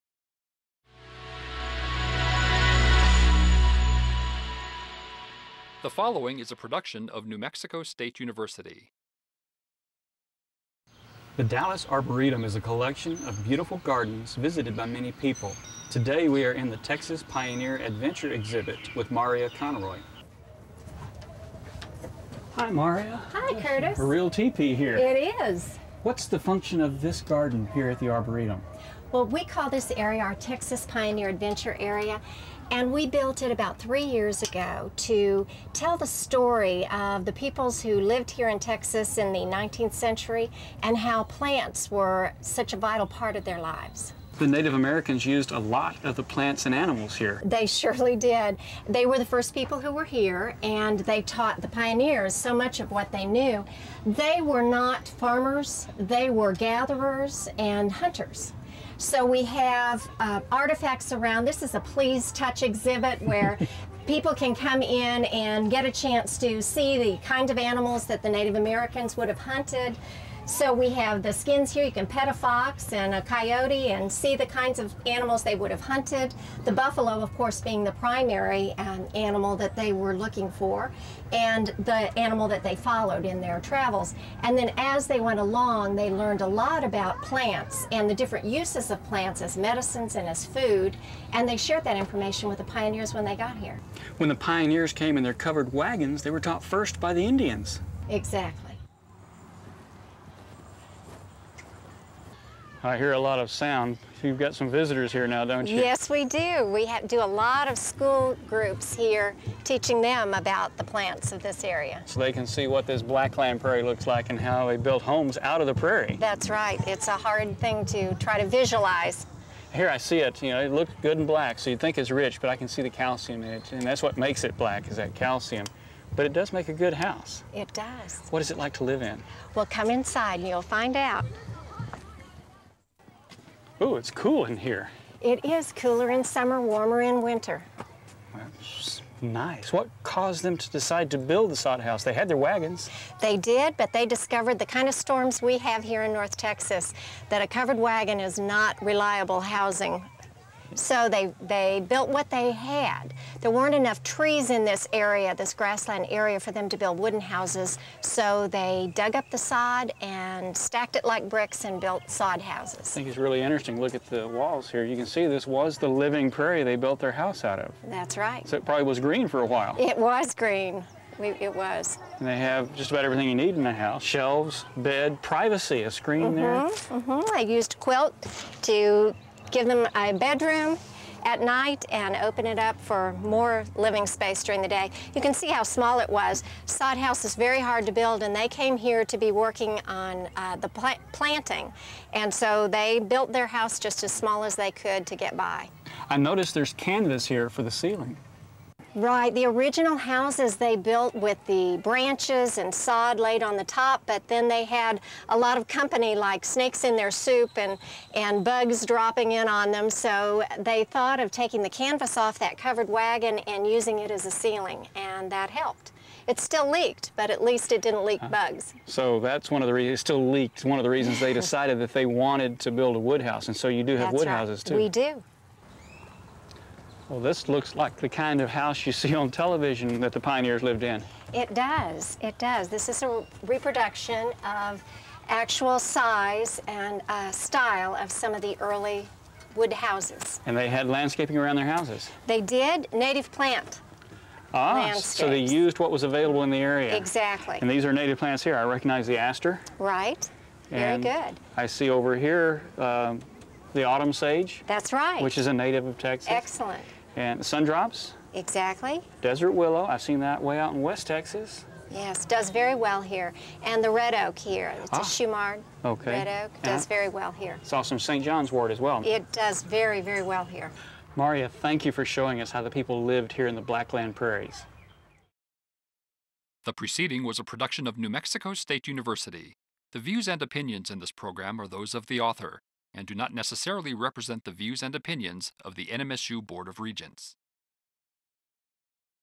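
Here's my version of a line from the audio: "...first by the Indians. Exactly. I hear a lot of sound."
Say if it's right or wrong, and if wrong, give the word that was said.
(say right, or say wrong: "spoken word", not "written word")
right.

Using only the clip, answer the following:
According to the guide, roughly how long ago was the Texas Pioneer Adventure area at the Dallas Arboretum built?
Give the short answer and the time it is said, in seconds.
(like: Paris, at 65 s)
3 years ago, at 33 s.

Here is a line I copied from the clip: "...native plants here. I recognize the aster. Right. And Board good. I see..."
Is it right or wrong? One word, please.
wrong.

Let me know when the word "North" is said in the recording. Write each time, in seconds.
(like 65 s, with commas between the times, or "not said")
146 s.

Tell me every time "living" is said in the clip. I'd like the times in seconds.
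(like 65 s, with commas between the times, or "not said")
165 s, 183 s.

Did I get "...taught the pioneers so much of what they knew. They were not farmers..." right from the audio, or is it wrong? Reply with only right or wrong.
right.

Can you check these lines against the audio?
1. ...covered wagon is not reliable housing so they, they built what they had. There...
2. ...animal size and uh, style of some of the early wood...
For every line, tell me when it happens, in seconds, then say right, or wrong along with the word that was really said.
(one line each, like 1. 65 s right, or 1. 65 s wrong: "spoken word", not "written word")
1. 147 s right
2. 235 s wrong: "actual", not "animal".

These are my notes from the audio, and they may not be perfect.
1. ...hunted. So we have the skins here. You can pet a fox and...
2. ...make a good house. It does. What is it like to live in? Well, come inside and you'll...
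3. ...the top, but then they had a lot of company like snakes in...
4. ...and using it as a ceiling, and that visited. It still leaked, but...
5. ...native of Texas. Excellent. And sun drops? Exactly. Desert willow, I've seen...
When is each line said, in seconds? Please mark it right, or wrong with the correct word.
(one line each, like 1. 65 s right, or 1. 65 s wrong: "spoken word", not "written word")
1. 69 s right
2. 126 s right
3. 203 s right
4. 213 s wrong: "helped", not "visited"
5. 255 s right.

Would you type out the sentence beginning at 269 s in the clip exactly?
It does very, very well here.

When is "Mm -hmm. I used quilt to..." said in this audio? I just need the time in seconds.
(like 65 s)
176 s.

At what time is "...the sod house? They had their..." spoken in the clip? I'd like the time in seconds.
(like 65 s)
141 s.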